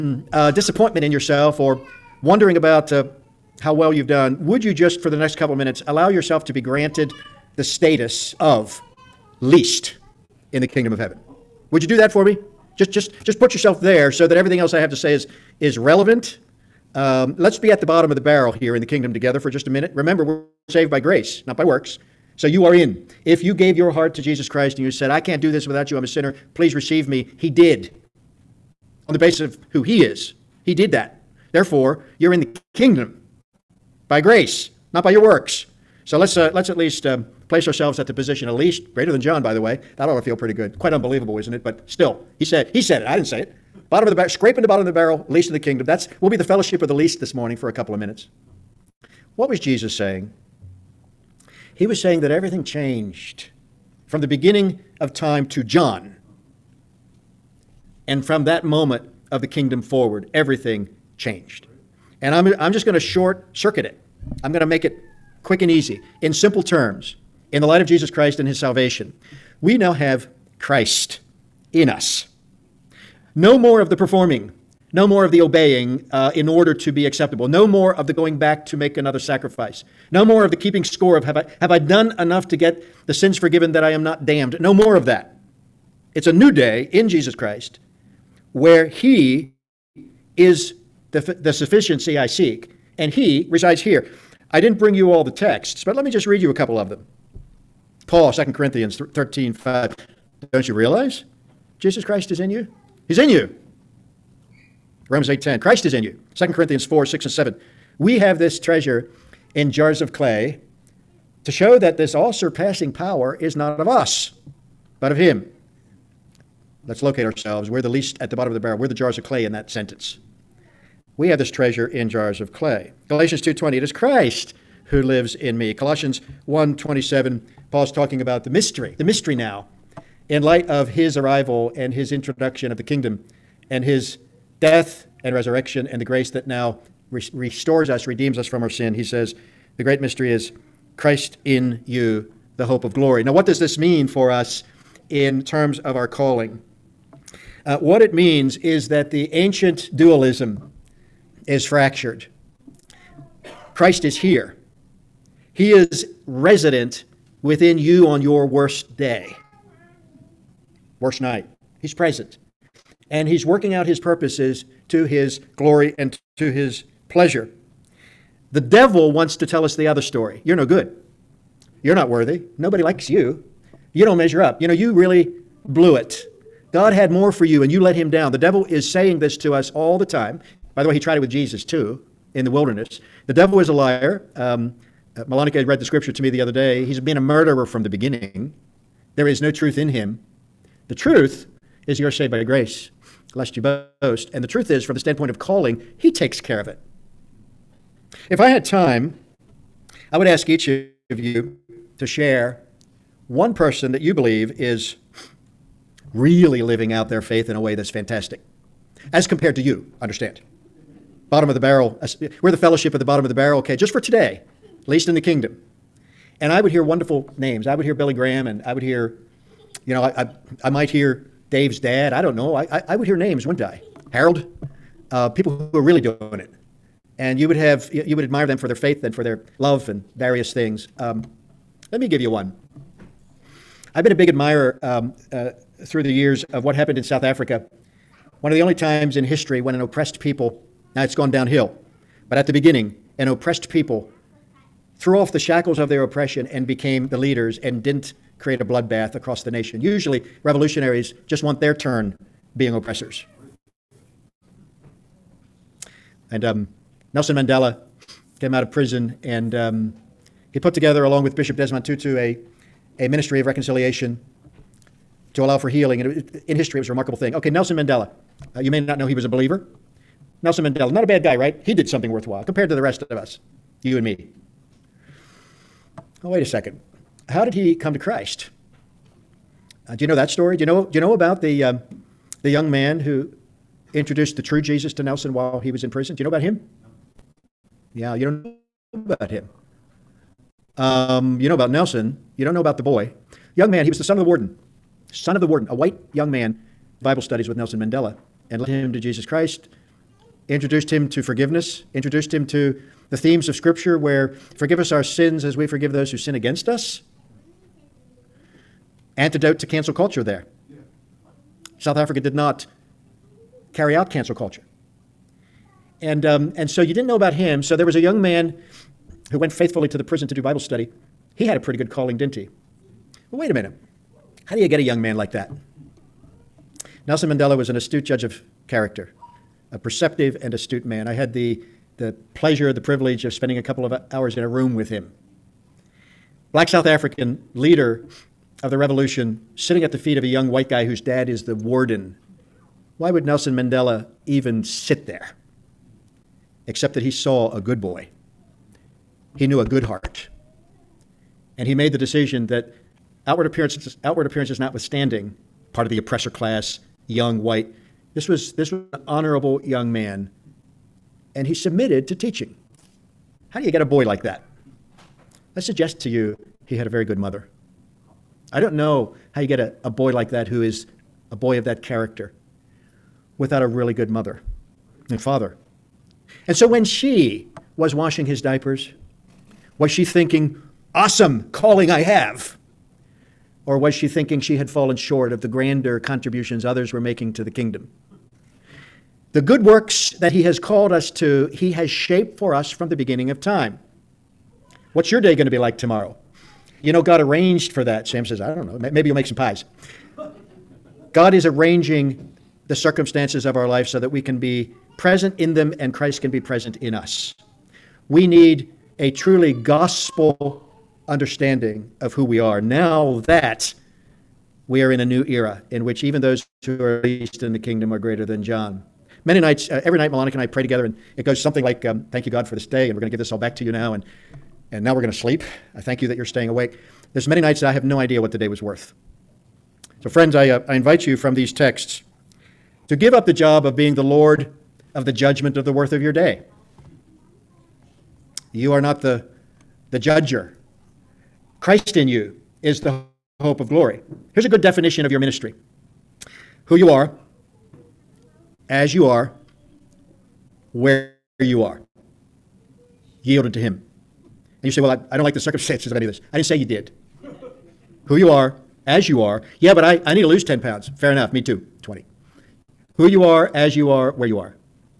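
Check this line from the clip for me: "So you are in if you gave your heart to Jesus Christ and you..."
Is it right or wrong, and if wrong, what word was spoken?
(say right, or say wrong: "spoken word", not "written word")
right.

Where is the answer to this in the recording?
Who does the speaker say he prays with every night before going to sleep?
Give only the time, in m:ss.
7:00.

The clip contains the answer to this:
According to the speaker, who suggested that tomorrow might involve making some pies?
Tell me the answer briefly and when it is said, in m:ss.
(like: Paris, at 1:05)
Sam, at 6:38.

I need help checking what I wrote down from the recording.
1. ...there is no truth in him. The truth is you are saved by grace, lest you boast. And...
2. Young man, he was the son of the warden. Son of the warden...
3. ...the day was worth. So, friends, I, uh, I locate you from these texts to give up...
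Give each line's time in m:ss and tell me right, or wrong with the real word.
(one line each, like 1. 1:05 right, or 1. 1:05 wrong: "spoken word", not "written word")
1. 3:09 right
2. 4:53 right
3. 7:08 wrong: "invite", not "locate".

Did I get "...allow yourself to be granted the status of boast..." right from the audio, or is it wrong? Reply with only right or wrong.
wrong.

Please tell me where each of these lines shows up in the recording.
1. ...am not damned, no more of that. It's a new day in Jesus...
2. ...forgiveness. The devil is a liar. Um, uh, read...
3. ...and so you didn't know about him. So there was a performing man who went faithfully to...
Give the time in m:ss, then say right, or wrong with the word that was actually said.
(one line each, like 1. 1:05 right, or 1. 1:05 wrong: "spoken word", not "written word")
1. 1:23 right
2. 3:02 wrong: "wilderness", not "forgiveness"
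3. 5:16 wrong: "young", not "performing".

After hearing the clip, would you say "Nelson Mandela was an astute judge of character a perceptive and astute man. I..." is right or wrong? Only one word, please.
right.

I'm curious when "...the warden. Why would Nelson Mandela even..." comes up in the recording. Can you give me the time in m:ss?
5:41.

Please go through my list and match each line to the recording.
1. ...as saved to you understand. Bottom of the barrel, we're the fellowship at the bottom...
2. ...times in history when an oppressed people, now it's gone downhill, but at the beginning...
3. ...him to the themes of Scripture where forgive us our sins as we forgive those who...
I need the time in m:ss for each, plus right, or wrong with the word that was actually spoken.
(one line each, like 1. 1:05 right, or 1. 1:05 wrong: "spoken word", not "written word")
1. 3:29 wrong: "compared", not "saved"
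2. 3:58 right
3. 5:02 right.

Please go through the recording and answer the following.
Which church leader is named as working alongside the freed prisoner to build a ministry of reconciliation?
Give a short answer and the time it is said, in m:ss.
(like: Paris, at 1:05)
Desmond Tutu, at 4:21.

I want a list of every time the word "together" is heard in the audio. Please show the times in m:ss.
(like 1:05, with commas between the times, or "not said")
0:19, 4:20, 7:00.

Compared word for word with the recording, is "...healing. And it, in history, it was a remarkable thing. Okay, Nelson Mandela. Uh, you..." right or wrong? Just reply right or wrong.
right.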